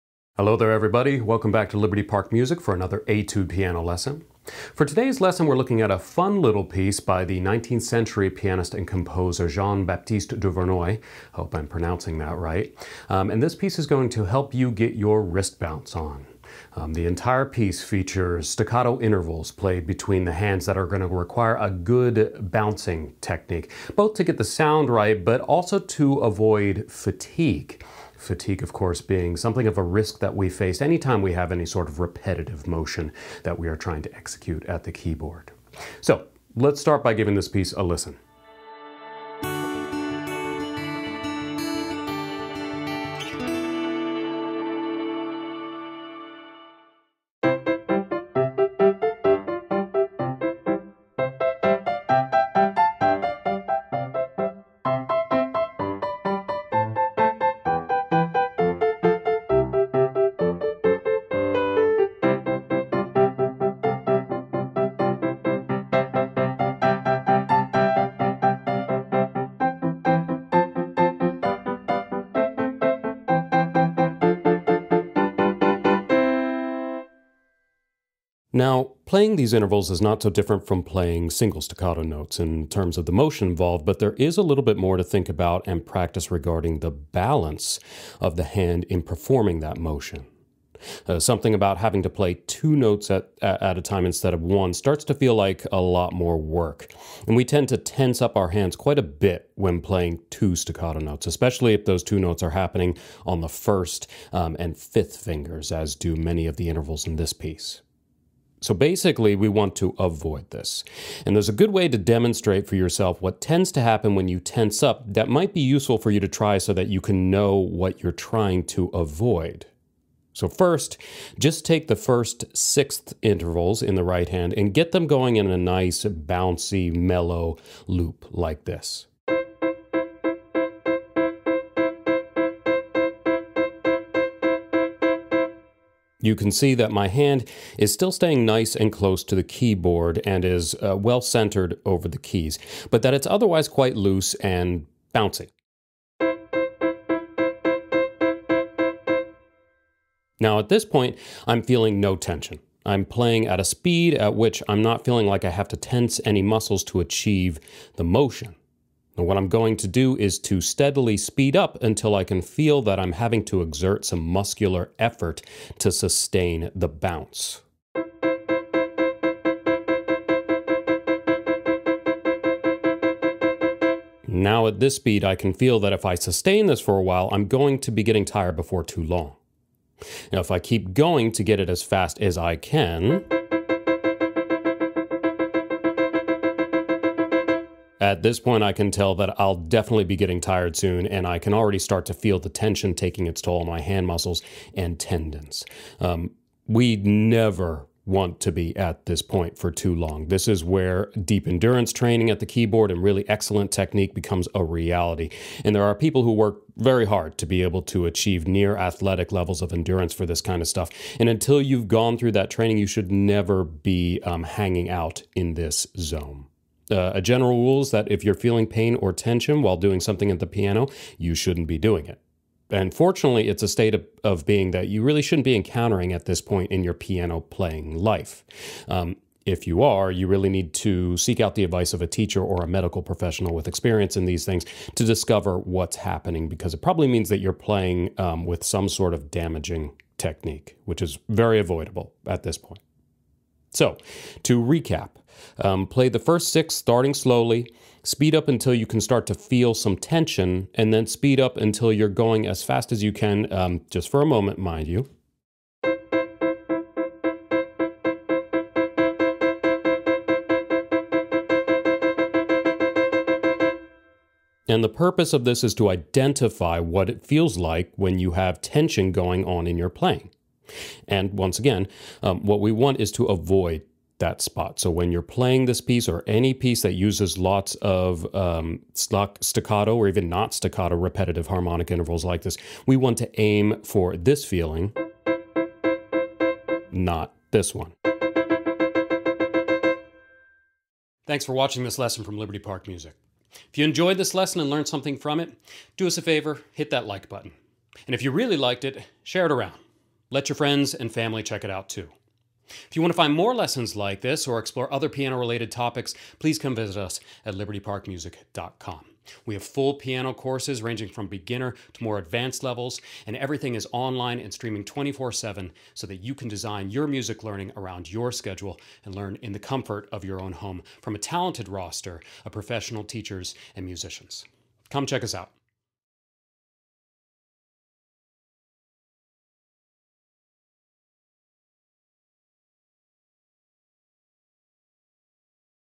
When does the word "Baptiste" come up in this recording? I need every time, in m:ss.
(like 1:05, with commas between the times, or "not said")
0:09.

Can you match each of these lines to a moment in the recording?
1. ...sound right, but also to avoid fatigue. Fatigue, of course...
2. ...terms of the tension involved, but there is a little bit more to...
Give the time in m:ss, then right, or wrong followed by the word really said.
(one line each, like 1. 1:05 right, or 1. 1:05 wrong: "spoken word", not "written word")
1. 0:24 right
2. 1:22 wrong: "motion", not "tension".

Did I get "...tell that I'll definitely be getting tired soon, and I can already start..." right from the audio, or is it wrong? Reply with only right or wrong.
right.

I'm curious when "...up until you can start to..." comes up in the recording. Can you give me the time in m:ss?
4:08.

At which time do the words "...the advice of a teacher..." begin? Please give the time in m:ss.
3:51.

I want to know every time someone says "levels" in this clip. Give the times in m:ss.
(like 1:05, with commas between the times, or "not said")
3:29, 5:12.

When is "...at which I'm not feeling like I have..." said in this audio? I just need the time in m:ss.
2:34.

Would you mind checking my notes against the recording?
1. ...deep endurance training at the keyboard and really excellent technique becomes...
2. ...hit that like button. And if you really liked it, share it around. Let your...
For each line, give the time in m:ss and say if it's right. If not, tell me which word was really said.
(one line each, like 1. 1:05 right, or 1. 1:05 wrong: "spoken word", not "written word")
1. 3:21 right
2. 4:56 right.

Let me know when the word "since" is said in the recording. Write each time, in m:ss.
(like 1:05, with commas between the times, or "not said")
not said.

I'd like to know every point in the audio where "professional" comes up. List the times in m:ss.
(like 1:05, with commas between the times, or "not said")
3:53, 5:22.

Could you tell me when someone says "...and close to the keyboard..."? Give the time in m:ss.
2:18.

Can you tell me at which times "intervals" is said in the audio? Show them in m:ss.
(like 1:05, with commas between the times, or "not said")
0:18, 1:19, 1:46, 2:03, 4:41.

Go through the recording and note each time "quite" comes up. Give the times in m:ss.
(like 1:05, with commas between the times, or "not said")
1:38, 2:23.